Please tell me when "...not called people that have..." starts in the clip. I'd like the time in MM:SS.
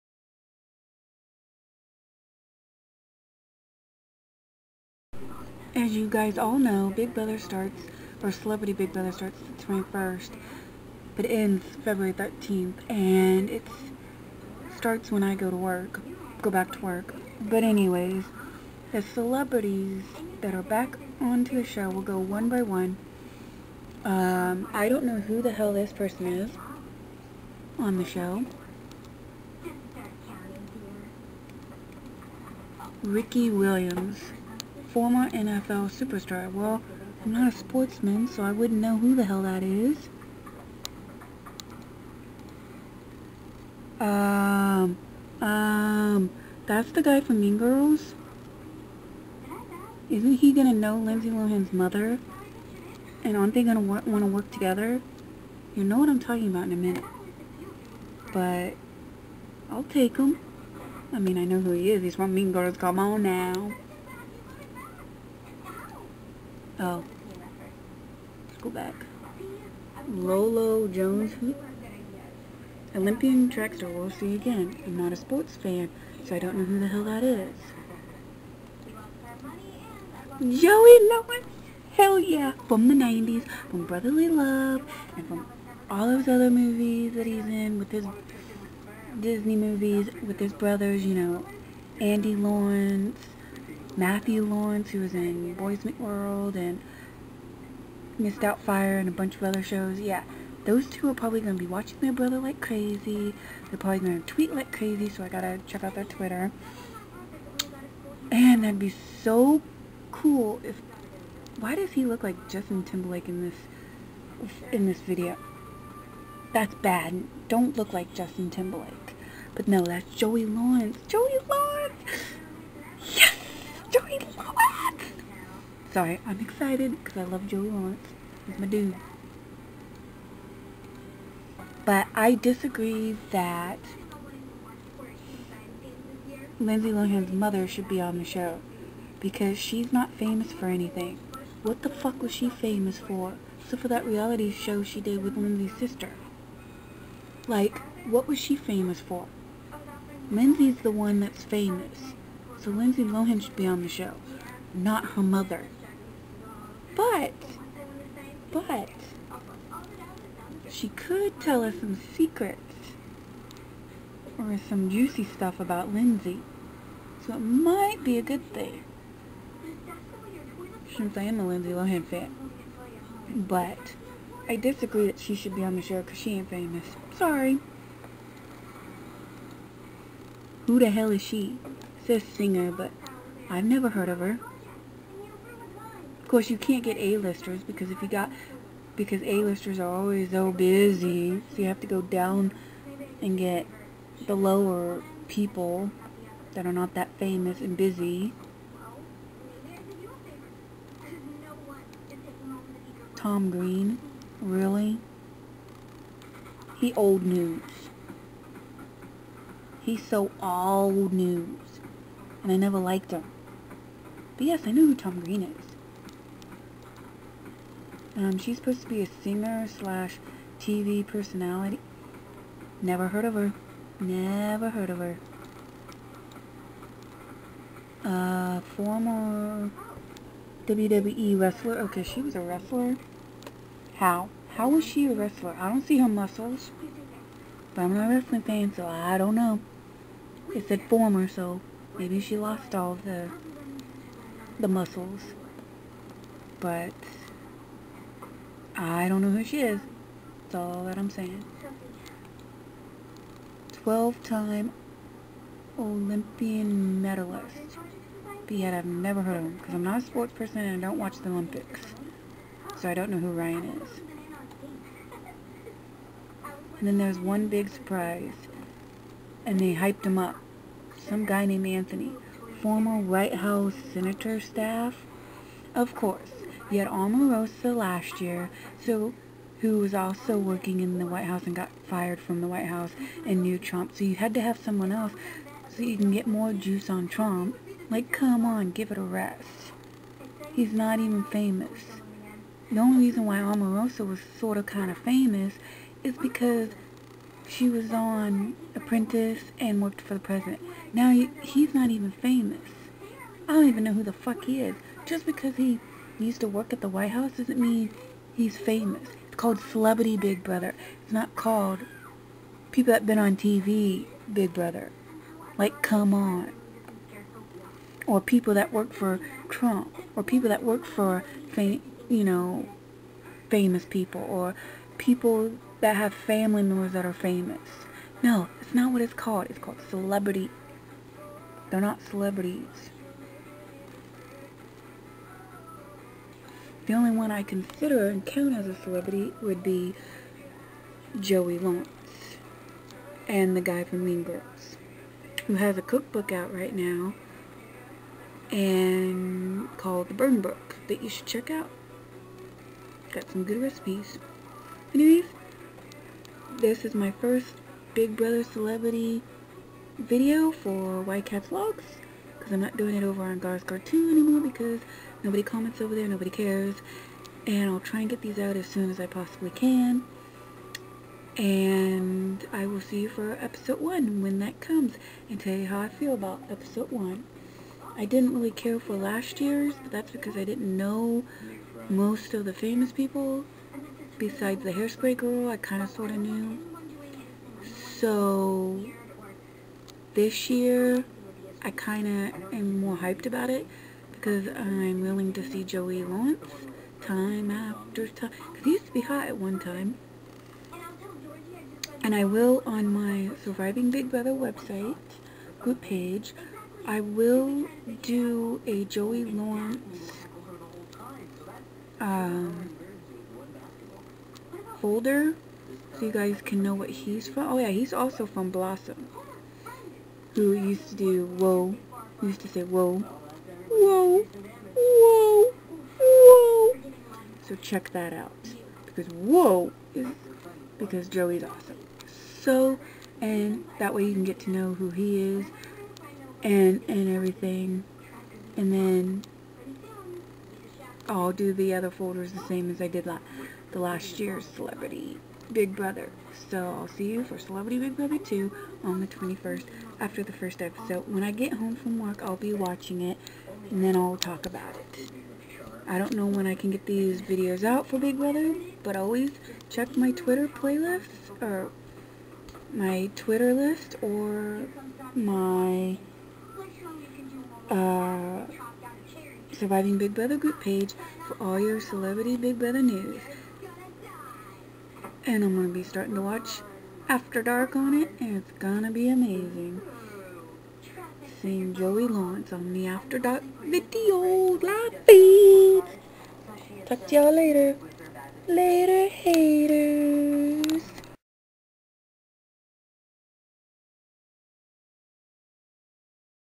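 05:11.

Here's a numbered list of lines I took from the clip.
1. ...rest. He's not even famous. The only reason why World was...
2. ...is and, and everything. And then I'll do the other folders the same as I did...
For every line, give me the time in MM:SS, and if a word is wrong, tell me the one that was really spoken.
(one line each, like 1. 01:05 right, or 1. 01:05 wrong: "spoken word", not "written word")
1. 04:49 wrong: "Omarosa", not "World"
2. 07:15 right.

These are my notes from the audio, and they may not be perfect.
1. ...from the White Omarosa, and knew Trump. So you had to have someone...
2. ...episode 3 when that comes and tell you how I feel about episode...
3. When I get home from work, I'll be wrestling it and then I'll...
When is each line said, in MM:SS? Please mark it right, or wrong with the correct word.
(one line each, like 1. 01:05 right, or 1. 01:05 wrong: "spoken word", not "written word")
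1. 04:42 wrong: "House", not "Omarosa"
2. 06:13 wrong: "1", not "3"
3. 07:31 wrong: "watching", not "wrestling".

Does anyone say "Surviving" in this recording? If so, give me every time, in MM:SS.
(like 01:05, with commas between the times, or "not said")
06:43, 07:49.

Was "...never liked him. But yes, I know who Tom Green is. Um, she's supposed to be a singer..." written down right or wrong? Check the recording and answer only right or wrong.
right.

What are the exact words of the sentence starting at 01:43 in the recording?
They're probably going to tweet like crazy, so I got to check out their Twitter.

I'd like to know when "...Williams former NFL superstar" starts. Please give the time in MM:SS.
00:33.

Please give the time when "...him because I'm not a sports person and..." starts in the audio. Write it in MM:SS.
04:19.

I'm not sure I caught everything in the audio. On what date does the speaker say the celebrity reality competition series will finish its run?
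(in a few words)
February 13th.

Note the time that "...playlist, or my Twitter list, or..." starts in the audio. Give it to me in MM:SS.
07:40.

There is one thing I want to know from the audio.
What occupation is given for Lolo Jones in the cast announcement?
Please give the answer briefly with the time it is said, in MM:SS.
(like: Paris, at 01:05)
Olympian track star, at 01:12.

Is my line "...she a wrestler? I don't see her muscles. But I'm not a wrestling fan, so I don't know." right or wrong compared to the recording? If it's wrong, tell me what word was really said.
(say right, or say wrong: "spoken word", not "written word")
right.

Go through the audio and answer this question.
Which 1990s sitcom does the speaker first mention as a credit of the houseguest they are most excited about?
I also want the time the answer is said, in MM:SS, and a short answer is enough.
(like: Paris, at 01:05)
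Brotherly Love, at 01:23.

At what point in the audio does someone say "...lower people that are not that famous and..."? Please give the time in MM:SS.
03:14.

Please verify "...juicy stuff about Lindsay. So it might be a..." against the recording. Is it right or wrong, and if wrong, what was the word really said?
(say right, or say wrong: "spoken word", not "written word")
right.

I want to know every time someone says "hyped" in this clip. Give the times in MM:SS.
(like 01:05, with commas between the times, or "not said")
04:29, 06:32.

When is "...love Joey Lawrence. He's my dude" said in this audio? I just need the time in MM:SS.
02:07.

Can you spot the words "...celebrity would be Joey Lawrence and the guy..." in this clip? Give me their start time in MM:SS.
05:38.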